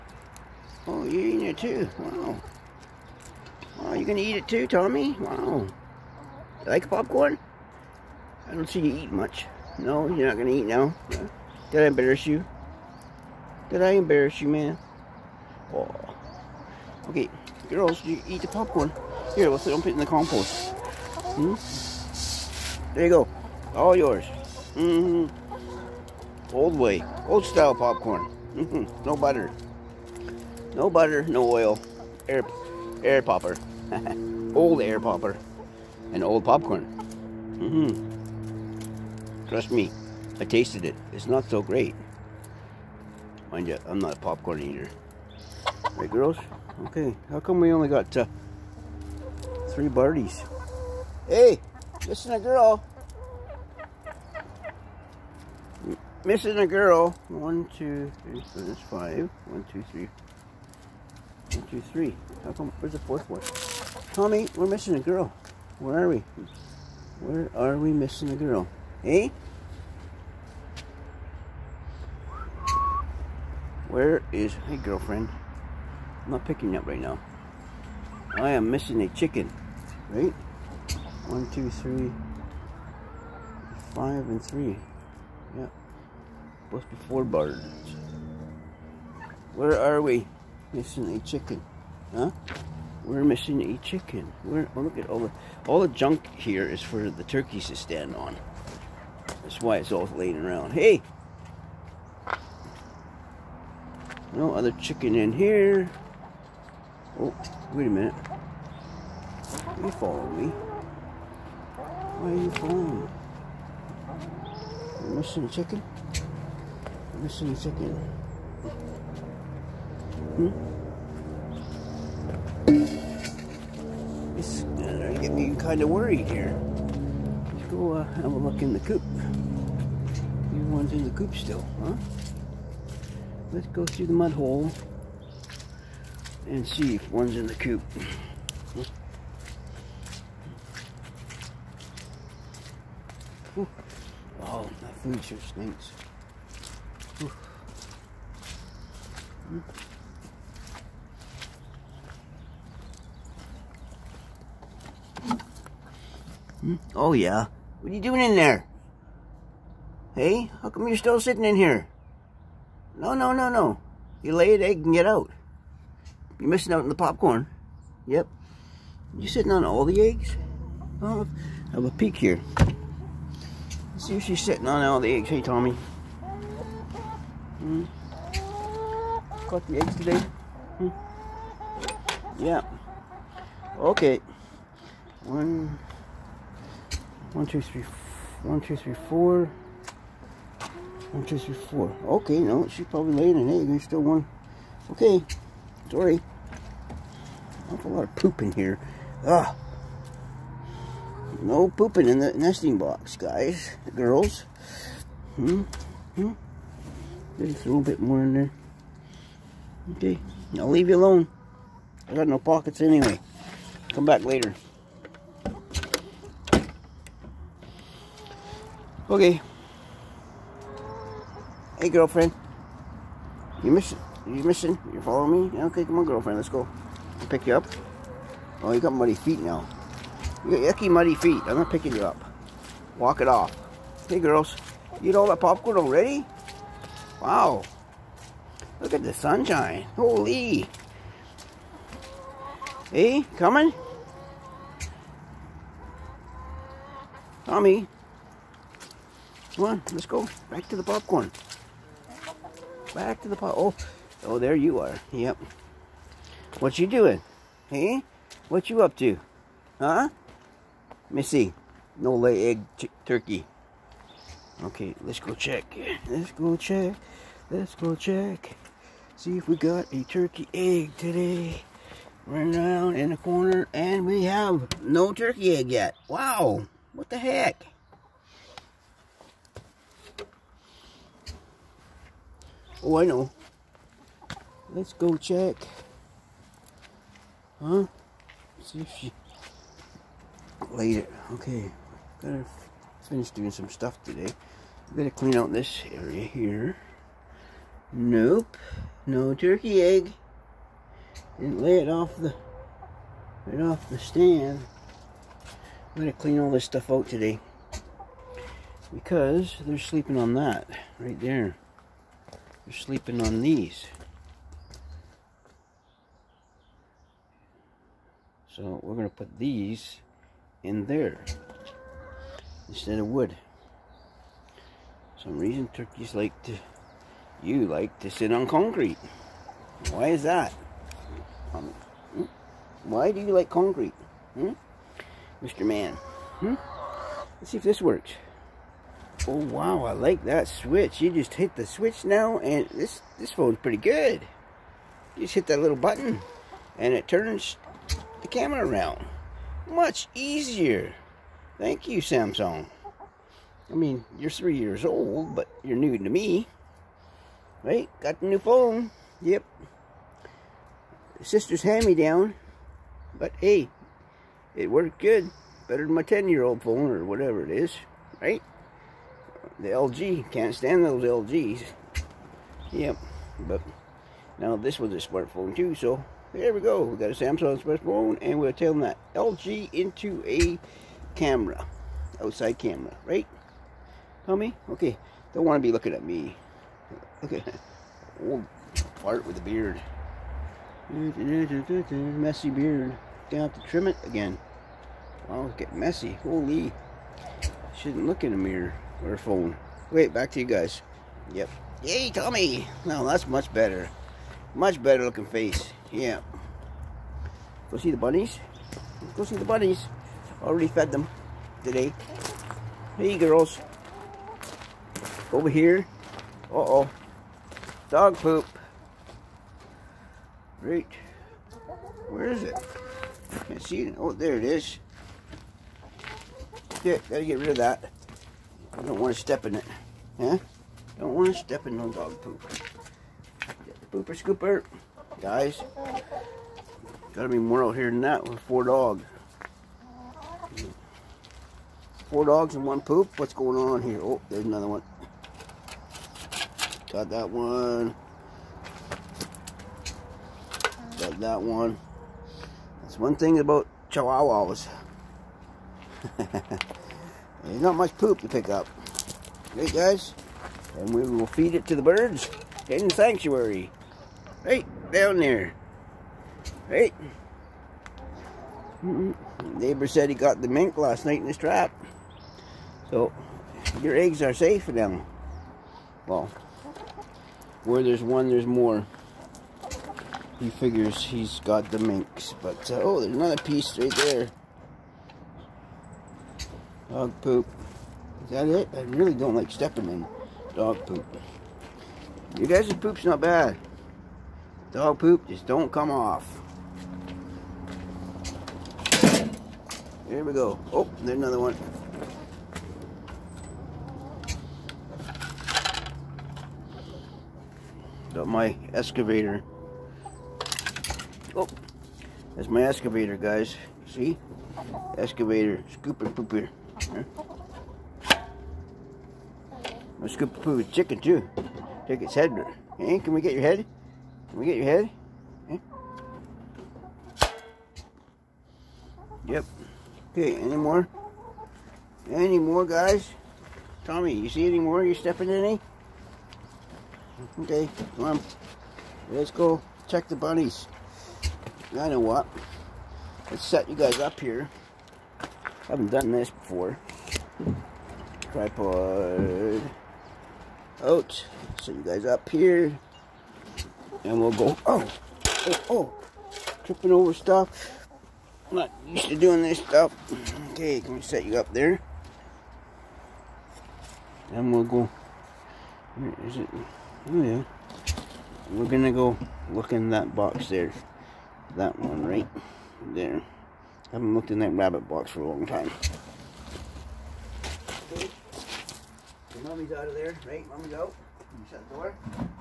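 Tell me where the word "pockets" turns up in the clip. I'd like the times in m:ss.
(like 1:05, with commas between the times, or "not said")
3:32.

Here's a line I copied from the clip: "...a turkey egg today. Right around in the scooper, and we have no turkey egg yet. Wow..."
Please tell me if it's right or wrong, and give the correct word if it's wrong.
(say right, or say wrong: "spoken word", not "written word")
wrong: "corner", not "scooper".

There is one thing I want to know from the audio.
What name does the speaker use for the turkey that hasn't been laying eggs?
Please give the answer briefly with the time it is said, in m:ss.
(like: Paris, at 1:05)
Missy, at 4:21.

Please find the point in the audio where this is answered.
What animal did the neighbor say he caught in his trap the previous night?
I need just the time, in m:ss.
7:50.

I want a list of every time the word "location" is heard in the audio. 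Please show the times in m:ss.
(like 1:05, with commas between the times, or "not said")
not said.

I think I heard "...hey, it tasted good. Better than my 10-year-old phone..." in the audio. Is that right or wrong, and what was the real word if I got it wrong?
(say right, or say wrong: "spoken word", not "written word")
wrong: "worked", not "tasted".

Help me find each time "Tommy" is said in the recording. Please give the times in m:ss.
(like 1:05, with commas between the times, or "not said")
0:04, 1:04, 2:55, 4:07, 6:24, 6:42, 8:53.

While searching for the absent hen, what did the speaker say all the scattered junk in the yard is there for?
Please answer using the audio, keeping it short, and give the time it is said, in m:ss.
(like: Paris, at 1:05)
For the turkeys to stand on, at 1:37.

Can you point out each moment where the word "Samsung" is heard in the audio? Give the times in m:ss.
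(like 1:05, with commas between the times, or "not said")
5:52, 6:17.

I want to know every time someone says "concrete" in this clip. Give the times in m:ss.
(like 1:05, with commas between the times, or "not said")
5:28, 5:33.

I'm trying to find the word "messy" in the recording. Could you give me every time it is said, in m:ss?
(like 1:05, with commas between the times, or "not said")
6:30, 6:35.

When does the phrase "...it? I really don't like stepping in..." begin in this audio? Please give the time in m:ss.
8:08.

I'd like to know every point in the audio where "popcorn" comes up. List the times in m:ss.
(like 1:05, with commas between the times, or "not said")
0:06, 0:18, 0:27, 0:36, 0:44, 2:46, 3:55, 4:10.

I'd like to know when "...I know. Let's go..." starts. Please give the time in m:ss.
4:42.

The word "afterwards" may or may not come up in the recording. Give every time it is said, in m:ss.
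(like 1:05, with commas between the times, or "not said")
not said.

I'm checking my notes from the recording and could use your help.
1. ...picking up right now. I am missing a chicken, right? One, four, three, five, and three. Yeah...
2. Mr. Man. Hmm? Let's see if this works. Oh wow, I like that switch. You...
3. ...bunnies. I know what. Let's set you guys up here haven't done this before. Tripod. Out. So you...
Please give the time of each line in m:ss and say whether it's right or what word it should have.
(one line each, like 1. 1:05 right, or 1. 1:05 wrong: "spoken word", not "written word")
1. 1:16 wrong: "two", not "four"
2. 5:35 right
3. 9:00 right.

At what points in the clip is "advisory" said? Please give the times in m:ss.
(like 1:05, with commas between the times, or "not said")
not said.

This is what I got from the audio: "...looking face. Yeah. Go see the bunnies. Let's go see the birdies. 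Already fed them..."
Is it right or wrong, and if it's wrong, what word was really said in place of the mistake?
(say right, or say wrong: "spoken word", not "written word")
wrong: "bunnies", not "birdies".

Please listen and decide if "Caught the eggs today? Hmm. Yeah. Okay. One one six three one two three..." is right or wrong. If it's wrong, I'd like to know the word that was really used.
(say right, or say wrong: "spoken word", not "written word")
wrong: "two", not "six".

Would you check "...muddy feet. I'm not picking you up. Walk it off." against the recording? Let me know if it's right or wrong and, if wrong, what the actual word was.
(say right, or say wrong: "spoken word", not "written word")
right.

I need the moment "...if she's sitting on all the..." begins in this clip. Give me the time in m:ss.
2:54.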